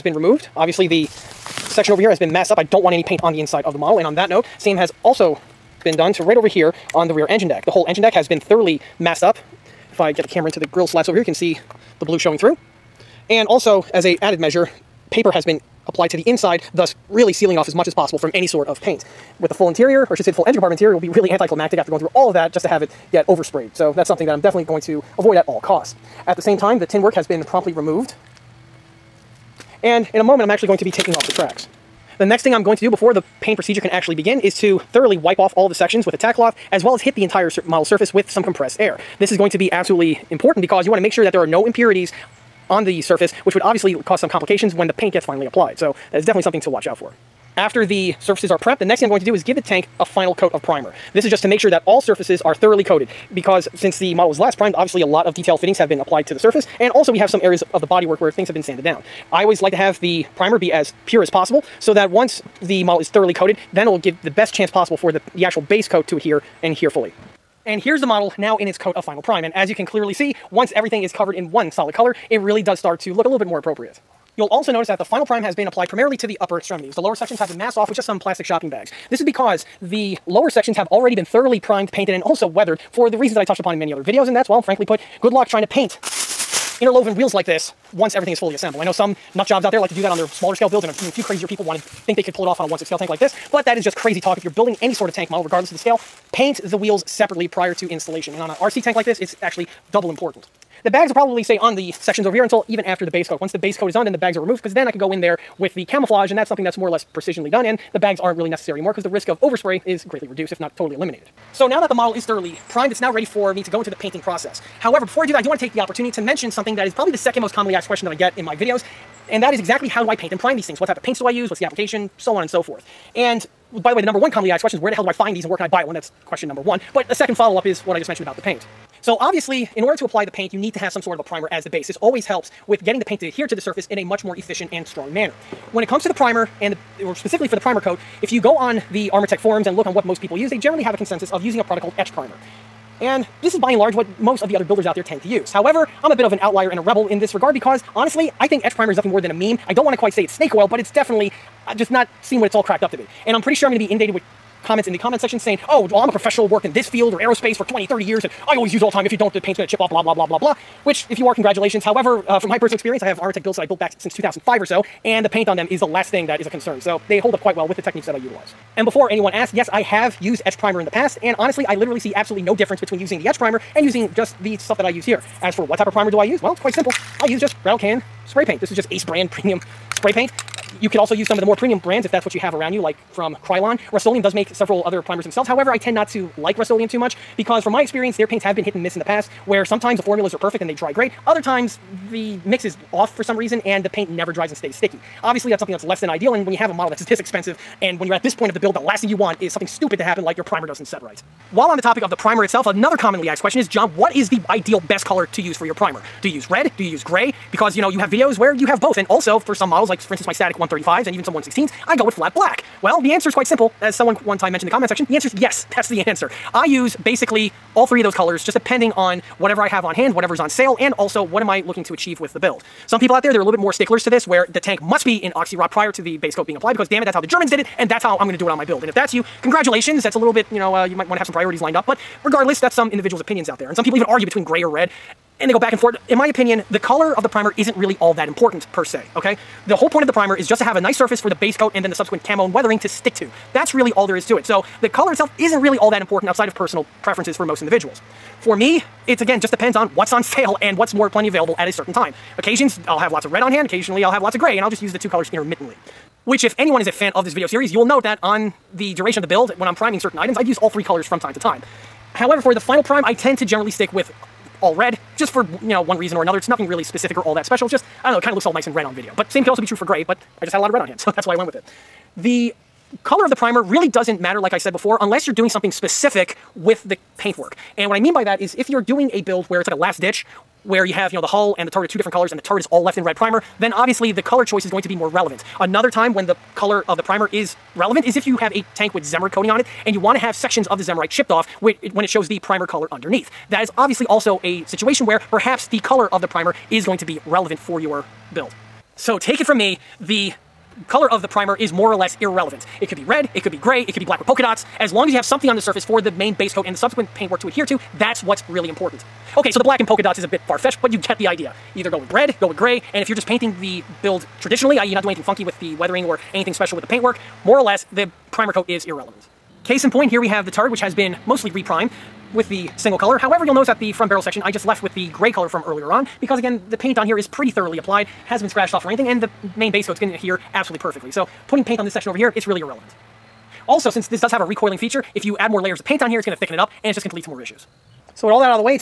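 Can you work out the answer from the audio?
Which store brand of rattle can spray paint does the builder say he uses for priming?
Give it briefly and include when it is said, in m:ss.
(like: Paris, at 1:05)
Ace, at 2:58.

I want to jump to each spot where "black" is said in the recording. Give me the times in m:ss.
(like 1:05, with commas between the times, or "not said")
3:32, 5:04, 5:09.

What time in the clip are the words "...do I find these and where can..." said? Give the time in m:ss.
2:05.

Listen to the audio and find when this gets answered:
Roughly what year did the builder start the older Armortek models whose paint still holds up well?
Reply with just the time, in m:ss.
2:44.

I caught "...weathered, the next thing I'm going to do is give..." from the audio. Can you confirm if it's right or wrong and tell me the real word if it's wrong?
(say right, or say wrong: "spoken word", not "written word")
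wrong: "prepped", not "weathered".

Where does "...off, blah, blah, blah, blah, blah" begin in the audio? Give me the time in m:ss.
2:39.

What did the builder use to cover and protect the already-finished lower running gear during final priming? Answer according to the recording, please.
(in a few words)
Plastic shopping bags.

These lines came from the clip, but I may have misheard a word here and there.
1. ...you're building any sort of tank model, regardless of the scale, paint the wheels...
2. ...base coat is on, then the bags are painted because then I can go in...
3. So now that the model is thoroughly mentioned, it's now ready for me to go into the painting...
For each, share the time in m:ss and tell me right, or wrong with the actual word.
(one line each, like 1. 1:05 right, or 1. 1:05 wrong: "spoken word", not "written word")
1. 1:34 right
2. 1:43 wrong: "removed", not "painted"
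3. 1:51 wrong: "primed", not "mentioned".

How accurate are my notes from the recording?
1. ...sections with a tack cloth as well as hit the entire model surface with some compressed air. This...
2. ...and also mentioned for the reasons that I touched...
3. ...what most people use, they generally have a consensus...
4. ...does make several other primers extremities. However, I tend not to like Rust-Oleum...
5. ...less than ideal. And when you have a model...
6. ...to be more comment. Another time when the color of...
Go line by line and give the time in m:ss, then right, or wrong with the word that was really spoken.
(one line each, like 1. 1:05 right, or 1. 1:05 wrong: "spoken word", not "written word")
1. 0:35 right
2. 1:22 wrong: "weathered", not "mentioned"
3. 2:19 right
4. 3:04 wrong: "themselves", not "extremities"
5. 3:15 right
6. 4:44 wrong: "relevant", not "comment".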